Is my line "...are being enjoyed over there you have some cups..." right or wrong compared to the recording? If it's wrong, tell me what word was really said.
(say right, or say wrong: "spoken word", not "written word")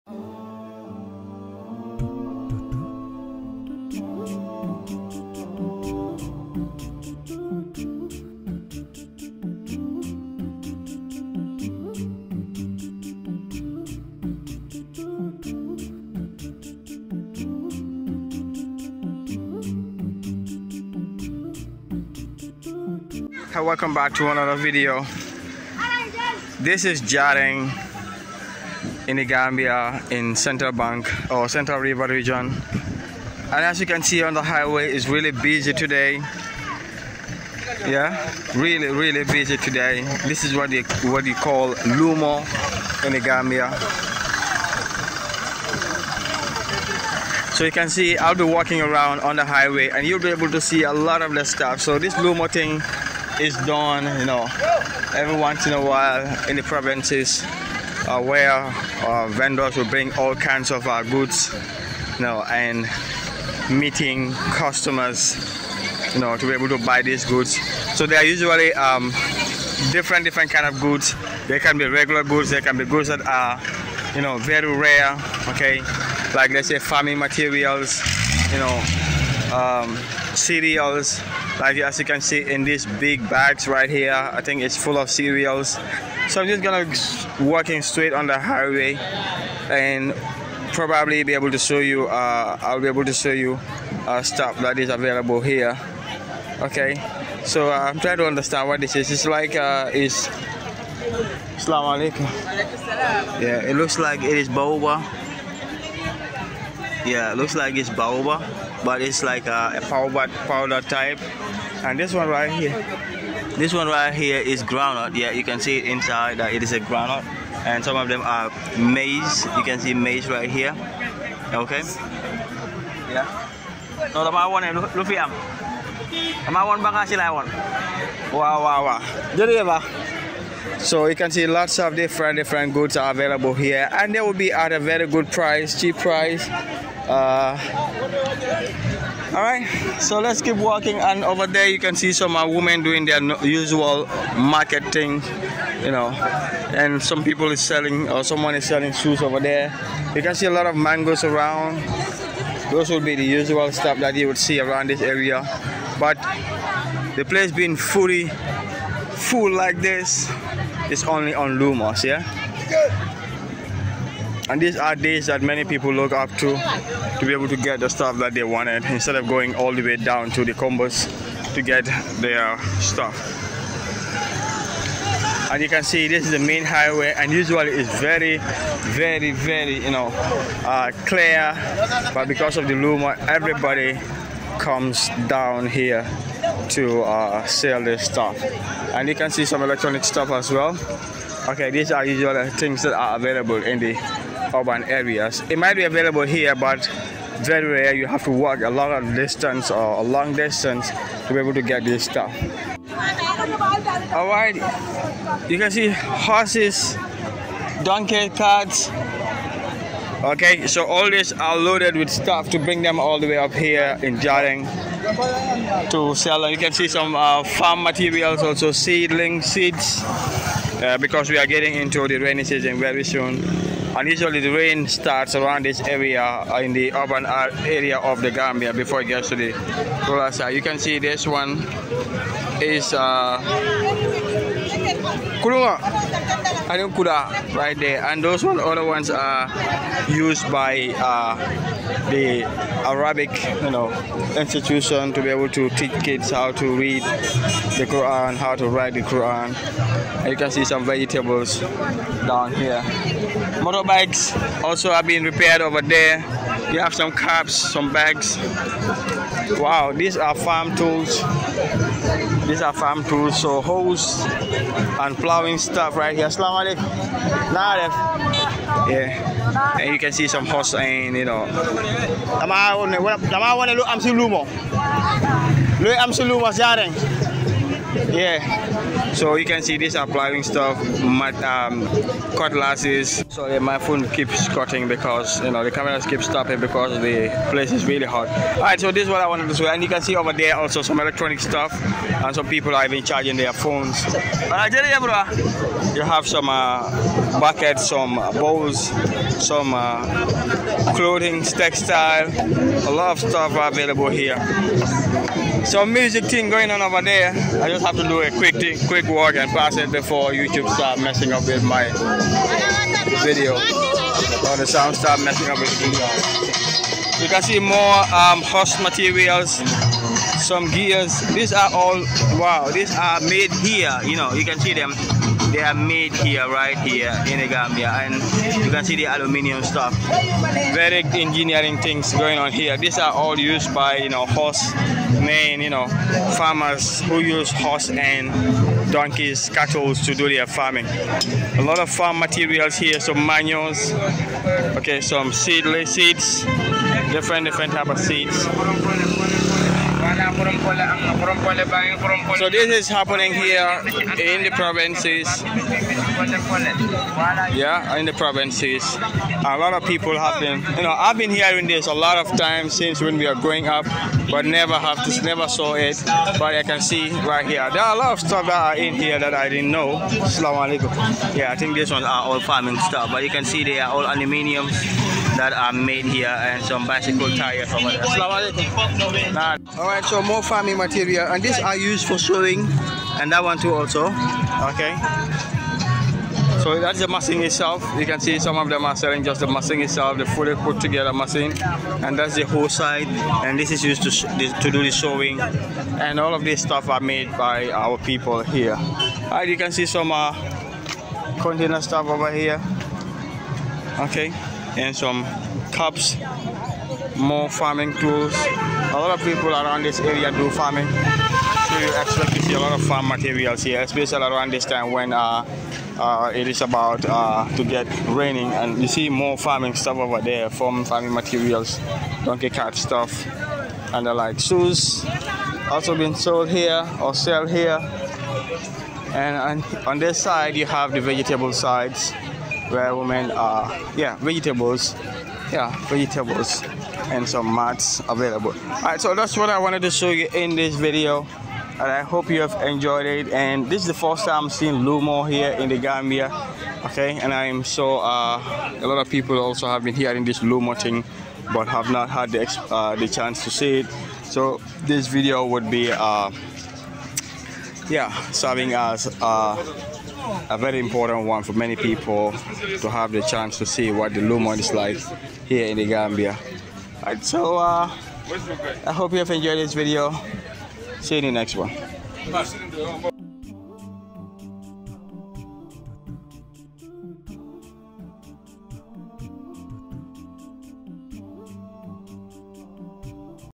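wrong: "repaired", not "enjoyed".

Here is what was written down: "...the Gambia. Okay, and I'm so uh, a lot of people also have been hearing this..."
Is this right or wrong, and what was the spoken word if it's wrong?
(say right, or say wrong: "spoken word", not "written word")
right.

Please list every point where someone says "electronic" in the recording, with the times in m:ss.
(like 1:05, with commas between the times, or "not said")
3:09, 4:50.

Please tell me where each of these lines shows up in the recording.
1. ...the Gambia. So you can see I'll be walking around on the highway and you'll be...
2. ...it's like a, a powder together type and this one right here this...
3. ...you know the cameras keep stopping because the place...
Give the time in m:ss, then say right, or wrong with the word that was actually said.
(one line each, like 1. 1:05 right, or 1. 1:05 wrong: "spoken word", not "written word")
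1. 0:43 right
2. 1:49 wrong: "powder", not "together"
3. 4:45 right.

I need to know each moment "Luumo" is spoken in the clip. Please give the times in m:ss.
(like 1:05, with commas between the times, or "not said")
0:41, 0:52, 2:41, 7:24, 7:30.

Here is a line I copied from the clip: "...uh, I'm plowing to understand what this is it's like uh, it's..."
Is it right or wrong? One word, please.
wrong.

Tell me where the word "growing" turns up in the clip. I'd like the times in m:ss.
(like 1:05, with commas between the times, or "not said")
6:03.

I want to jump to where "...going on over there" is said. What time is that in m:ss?
5:06.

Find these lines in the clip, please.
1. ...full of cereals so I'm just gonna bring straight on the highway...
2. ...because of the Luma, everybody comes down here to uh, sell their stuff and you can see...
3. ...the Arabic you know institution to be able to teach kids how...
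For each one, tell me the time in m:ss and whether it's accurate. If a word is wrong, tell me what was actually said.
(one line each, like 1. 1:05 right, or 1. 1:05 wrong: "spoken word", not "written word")
1. 1:24 wrong: "walking", not "bring"
2. 3:02 right
3. 4:02 right.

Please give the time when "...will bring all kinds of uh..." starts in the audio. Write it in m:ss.
0:59.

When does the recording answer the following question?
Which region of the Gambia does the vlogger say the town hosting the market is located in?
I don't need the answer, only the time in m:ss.
0:31.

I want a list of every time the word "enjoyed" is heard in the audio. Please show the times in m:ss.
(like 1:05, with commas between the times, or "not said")
7:22, 7:49.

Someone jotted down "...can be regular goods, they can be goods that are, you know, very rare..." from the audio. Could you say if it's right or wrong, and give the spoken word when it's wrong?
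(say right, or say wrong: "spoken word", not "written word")
right.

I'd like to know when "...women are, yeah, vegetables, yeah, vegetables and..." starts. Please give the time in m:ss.
7:12.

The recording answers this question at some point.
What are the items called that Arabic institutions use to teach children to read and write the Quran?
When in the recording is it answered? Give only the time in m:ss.
3:55.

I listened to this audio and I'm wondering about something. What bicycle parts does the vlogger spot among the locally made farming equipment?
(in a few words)
Bicycle tires.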